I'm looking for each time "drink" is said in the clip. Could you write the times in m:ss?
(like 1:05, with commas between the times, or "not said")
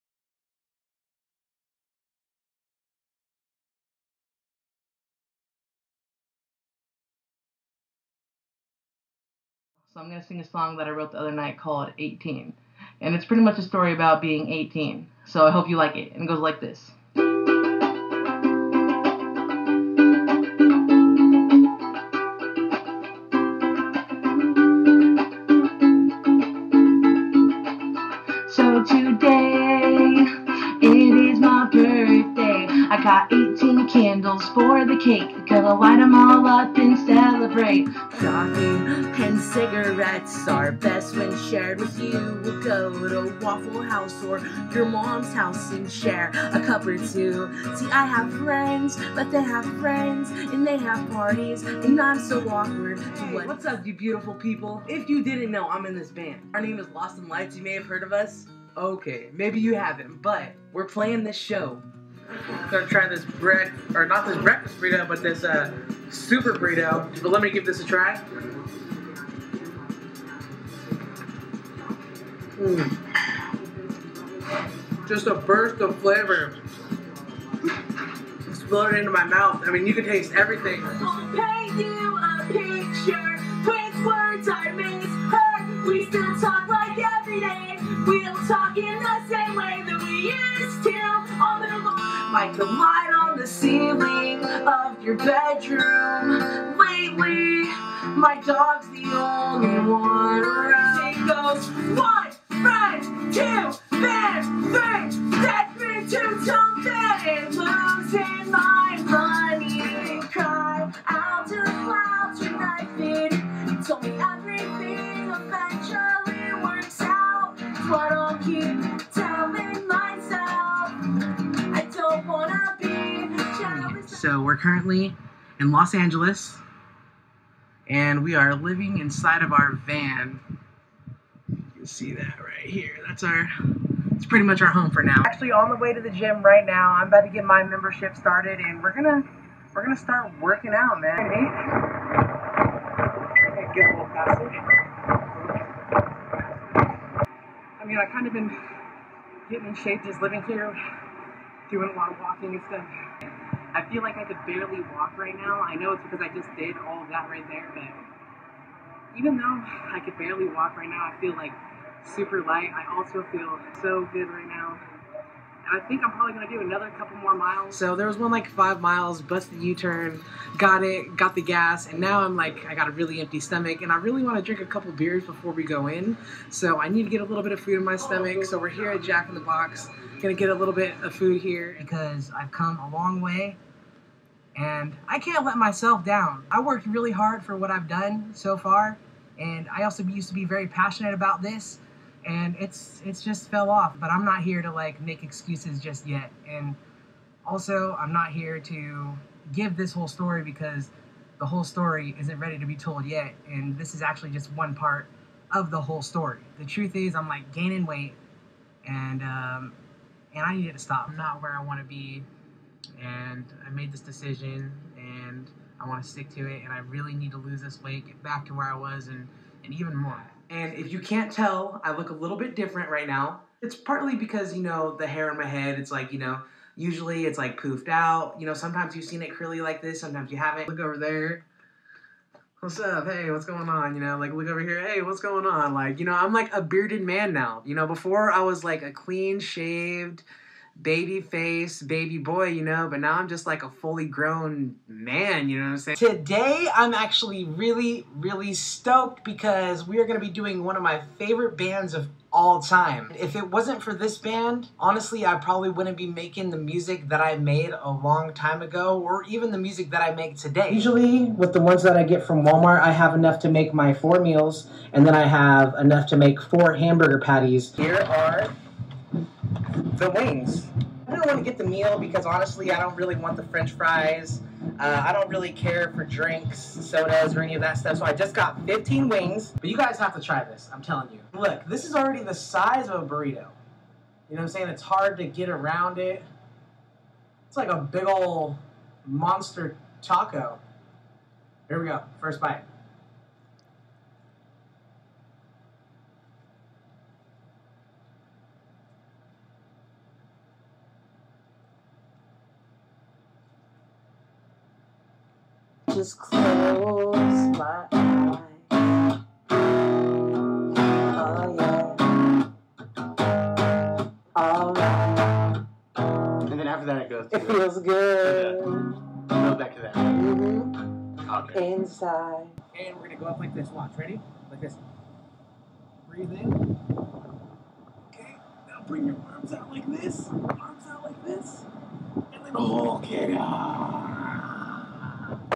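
2:54, 4:36.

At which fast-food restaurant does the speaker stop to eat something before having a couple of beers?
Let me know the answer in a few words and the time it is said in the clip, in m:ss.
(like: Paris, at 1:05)
Jack in the Box, at 2:59.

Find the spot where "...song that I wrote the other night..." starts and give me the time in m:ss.
0:10.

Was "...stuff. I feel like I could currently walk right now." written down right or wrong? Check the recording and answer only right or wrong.
wrong.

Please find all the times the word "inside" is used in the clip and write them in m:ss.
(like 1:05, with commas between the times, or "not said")
2:08, 5:21.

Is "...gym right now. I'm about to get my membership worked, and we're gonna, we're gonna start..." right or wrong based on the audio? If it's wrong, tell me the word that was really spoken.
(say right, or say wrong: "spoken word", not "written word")
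wrong: "started", not "worked".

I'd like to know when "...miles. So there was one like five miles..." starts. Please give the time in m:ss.
2:47.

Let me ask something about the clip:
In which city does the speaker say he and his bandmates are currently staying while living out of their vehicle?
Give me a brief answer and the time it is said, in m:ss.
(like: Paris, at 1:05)
Los Angeles, at 2:05.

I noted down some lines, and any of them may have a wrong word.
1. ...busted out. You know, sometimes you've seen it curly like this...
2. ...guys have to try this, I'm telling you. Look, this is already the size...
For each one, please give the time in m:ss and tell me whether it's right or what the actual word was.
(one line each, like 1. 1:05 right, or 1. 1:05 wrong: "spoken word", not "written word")
1. 3:47 wrong: "poofed", not "busted"
2. 4:39 right.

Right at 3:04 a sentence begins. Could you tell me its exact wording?
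And I can't let myself down.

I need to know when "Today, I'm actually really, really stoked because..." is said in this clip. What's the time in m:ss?
4:05.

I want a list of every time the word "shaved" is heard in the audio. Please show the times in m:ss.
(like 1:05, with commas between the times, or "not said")
3:59.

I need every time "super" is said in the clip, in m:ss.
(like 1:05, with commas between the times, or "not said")
1:06, 2:42.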